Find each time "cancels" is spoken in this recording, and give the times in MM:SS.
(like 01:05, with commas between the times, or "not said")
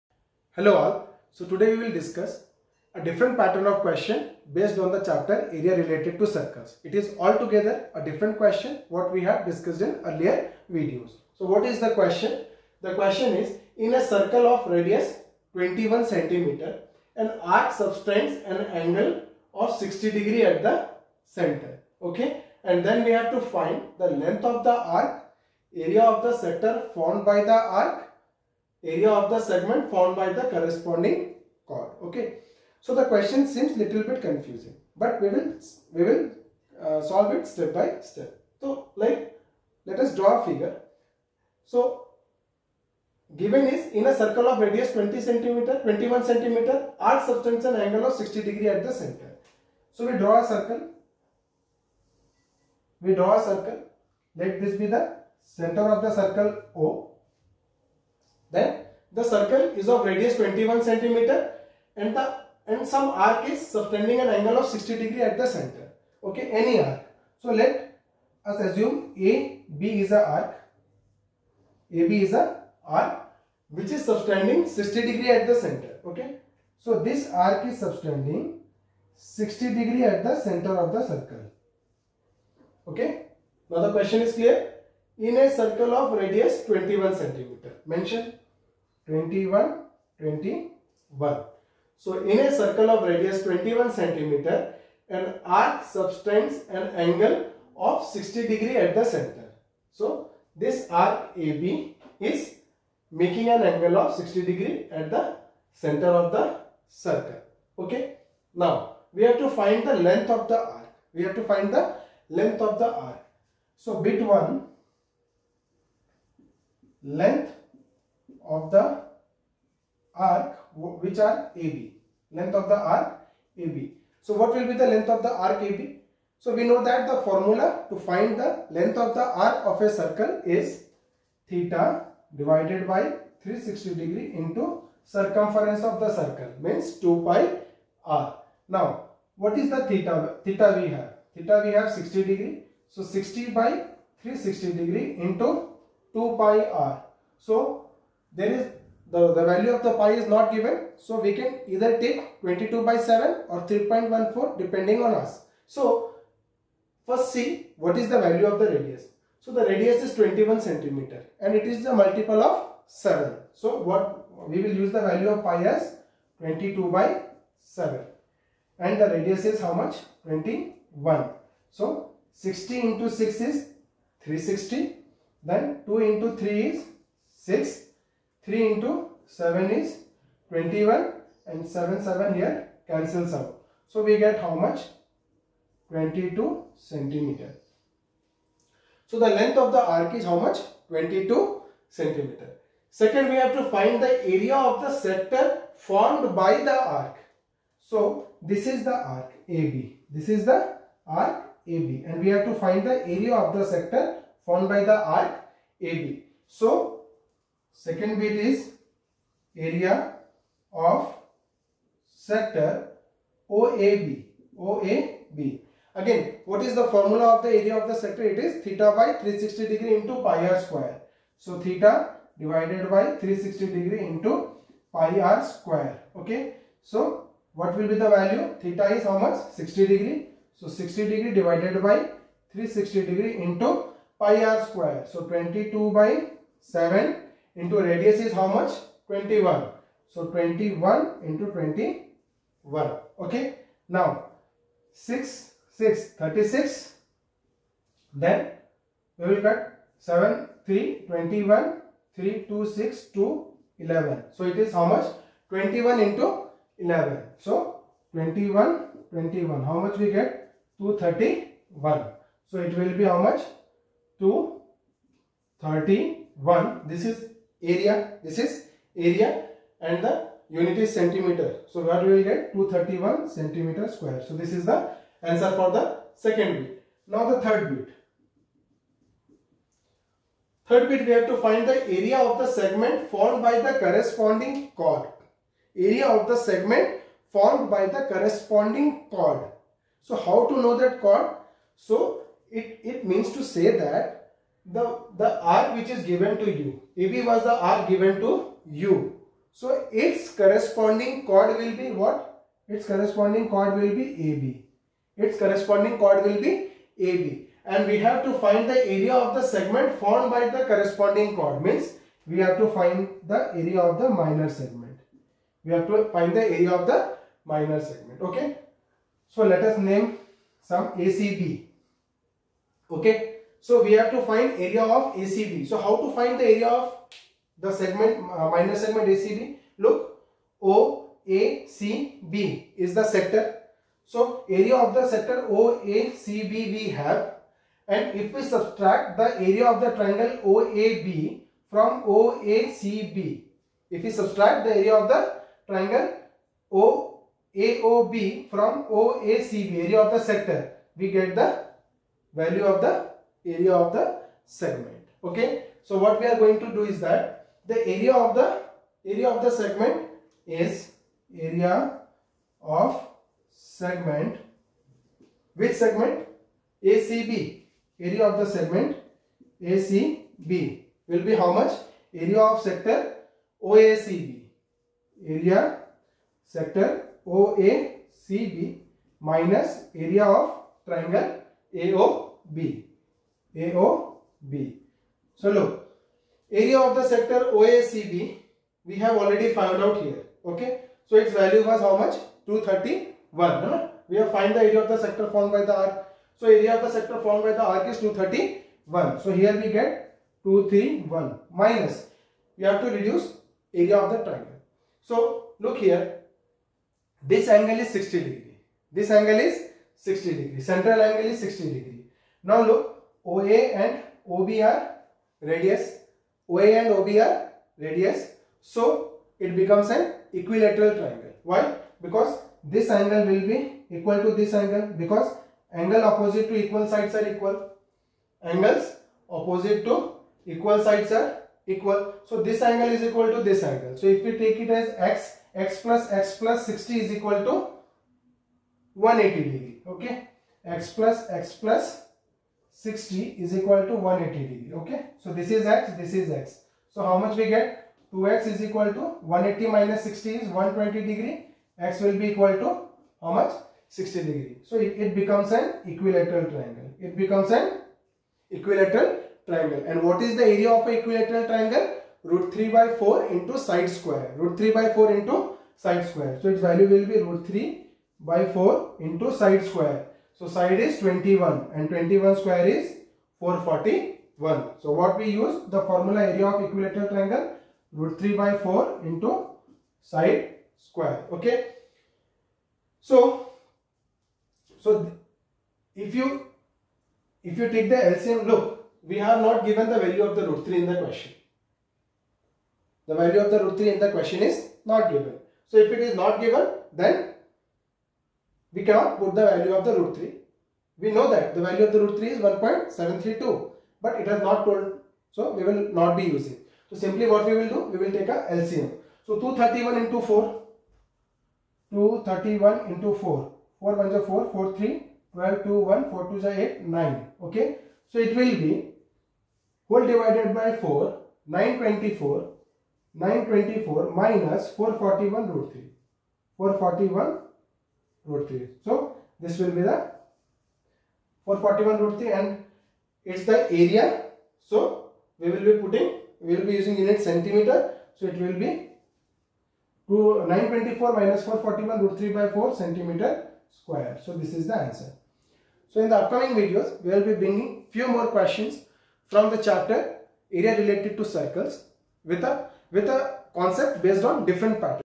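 03:02.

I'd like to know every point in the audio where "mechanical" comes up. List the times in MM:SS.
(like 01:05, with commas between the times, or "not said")
not said.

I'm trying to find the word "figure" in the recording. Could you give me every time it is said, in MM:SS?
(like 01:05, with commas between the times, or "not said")
00:40.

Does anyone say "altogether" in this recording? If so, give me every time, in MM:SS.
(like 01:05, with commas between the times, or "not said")
00:07.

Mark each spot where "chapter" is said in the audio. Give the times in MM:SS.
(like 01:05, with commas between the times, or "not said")
00:04, 09:09.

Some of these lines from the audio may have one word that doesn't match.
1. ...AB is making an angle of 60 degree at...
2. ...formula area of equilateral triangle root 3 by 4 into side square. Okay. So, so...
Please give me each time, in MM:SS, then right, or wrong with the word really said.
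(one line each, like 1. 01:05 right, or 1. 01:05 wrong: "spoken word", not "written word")
1. 01:41 right
2. 07:55 right.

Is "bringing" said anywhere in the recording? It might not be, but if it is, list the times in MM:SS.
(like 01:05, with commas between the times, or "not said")
09:07.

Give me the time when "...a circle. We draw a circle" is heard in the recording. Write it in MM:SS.
00:50.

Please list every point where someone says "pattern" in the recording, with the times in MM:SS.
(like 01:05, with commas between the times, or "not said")
00:03, 09:14.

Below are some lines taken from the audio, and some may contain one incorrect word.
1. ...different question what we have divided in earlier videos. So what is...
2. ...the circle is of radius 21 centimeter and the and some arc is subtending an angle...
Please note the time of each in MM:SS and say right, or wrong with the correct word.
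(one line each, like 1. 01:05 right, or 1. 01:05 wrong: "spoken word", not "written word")
1. 00:08 wrong: "discussed", not "divided"
2. 00:59 right.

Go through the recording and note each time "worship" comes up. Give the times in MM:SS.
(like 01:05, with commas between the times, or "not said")
not said.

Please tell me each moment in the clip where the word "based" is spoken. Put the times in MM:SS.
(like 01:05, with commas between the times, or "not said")
00:04, 09:14.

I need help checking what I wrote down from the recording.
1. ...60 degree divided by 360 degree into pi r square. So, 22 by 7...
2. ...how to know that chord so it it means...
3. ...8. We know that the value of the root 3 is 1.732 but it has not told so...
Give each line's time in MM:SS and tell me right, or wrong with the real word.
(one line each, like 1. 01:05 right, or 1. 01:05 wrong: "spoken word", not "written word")
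1. 03:50 right
2. 04:50 right
3. 08:20 wrong: "3", not "8".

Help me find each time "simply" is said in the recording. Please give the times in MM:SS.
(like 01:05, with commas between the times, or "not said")
08:26.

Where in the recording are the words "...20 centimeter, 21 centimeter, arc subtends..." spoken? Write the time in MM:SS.
00:44.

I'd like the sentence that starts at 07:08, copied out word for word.
Angles opposite to equal sides are equal.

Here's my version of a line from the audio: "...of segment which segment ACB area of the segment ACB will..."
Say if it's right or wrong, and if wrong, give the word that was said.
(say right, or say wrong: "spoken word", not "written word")
right.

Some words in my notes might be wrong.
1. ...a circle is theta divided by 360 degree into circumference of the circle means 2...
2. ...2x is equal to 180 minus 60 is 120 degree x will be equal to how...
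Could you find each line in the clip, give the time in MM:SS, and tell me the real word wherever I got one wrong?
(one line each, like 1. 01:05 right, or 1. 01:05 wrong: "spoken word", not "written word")
1. 02:09 right
2. 07:28 right.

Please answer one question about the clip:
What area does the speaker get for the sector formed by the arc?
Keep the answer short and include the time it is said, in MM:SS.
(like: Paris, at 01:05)
231 cm², at 04:32.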